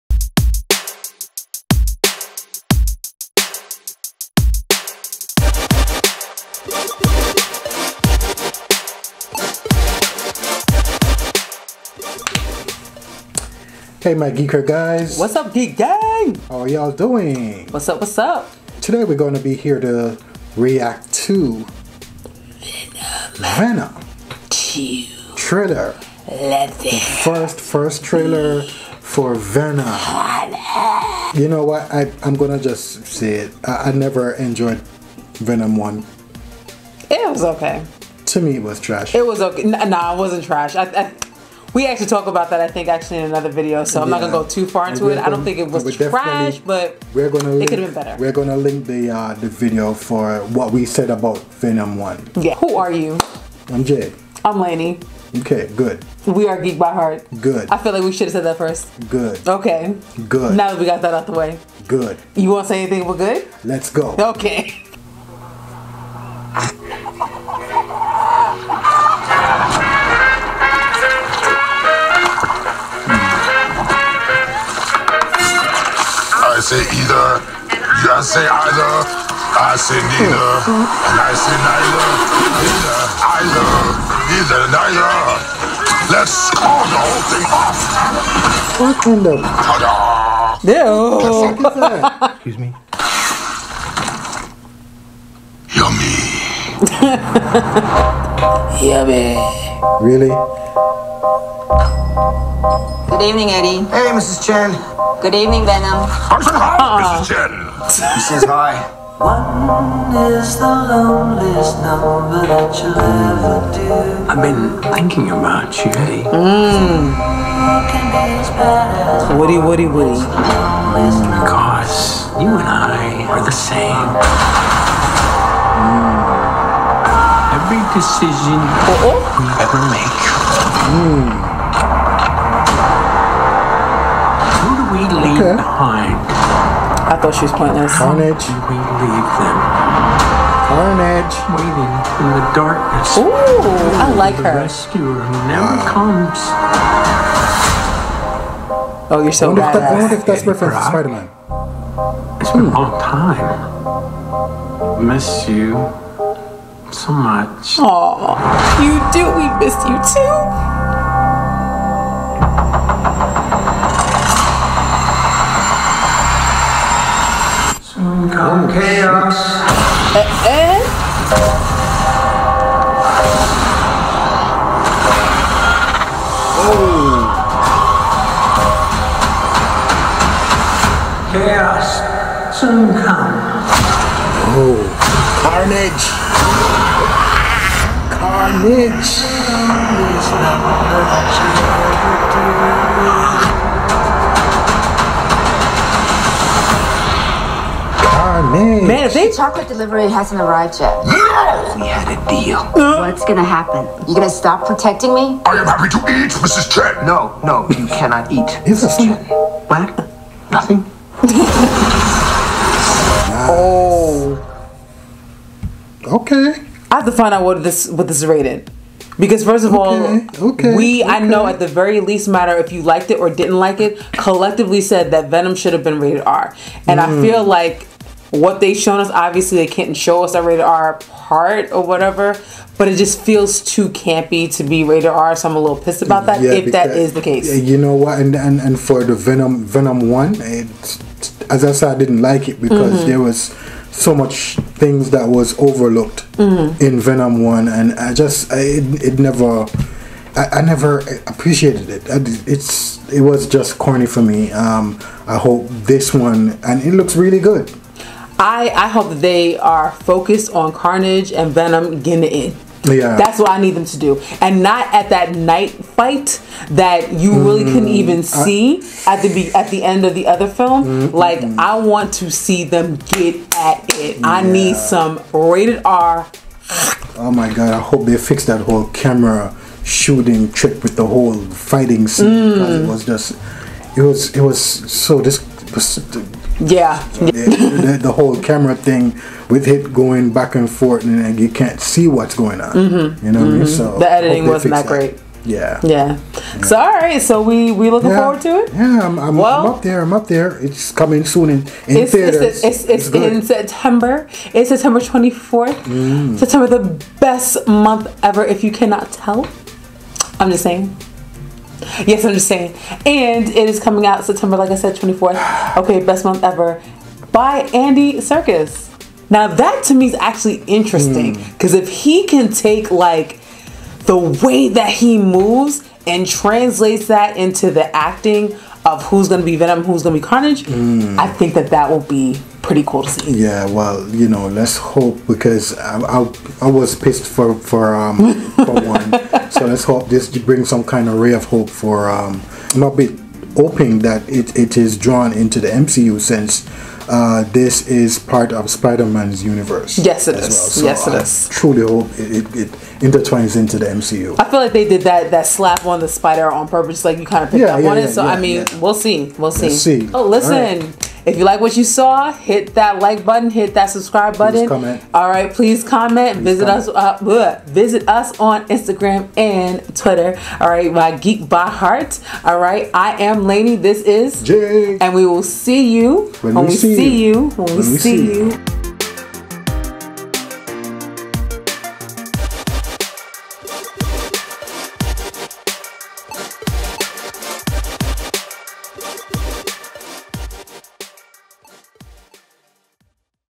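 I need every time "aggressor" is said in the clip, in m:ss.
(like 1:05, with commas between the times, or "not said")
not said.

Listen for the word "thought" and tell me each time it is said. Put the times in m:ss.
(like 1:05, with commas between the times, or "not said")
2:17.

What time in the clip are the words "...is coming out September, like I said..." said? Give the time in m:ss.
5:13.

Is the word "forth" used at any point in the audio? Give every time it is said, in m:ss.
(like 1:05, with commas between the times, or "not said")
4:50.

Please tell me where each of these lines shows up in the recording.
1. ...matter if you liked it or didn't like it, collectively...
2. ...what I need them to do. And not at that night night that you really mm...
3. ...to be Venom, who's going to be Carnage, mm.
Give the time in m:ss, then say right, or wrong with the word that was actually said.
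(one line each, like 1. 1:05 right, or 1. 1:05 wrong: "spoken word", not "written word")
1. 3:42 right
2. 4:23 wrong: "fight", not "night"
3. 5:29 right.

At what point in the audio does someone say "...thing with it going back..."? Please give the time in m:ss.
4:48.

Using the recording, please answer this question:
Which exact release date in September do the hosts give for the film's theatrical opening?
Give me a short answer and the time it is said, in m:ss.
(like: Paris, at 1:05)
September 24th, at 5:04.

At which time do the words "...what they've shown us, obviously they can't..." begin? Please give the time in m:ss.
3:48.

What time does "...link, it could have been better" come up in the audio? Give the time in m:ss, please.
0:47.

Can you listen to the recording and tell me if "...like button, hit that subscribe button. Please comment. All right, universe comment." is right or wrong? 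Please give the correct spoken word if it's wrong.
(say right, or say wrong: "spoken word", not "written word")
wrong: "please", not "universe".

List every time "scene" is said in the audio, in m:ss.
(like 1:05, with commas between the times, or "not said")
4:42.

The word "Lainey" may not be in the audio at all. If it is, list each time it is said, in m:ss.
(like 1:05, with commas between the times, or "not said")
0:54, 6:13.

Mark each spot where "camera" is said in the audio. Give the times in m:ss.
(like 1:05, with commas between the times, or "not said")
4:38, 4:48.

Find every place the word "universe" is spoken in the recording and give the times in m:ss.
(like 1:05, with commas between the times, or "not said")
5:49.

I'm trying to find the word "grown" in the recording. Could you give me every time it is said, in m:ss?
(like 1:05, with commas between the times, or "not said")
not said.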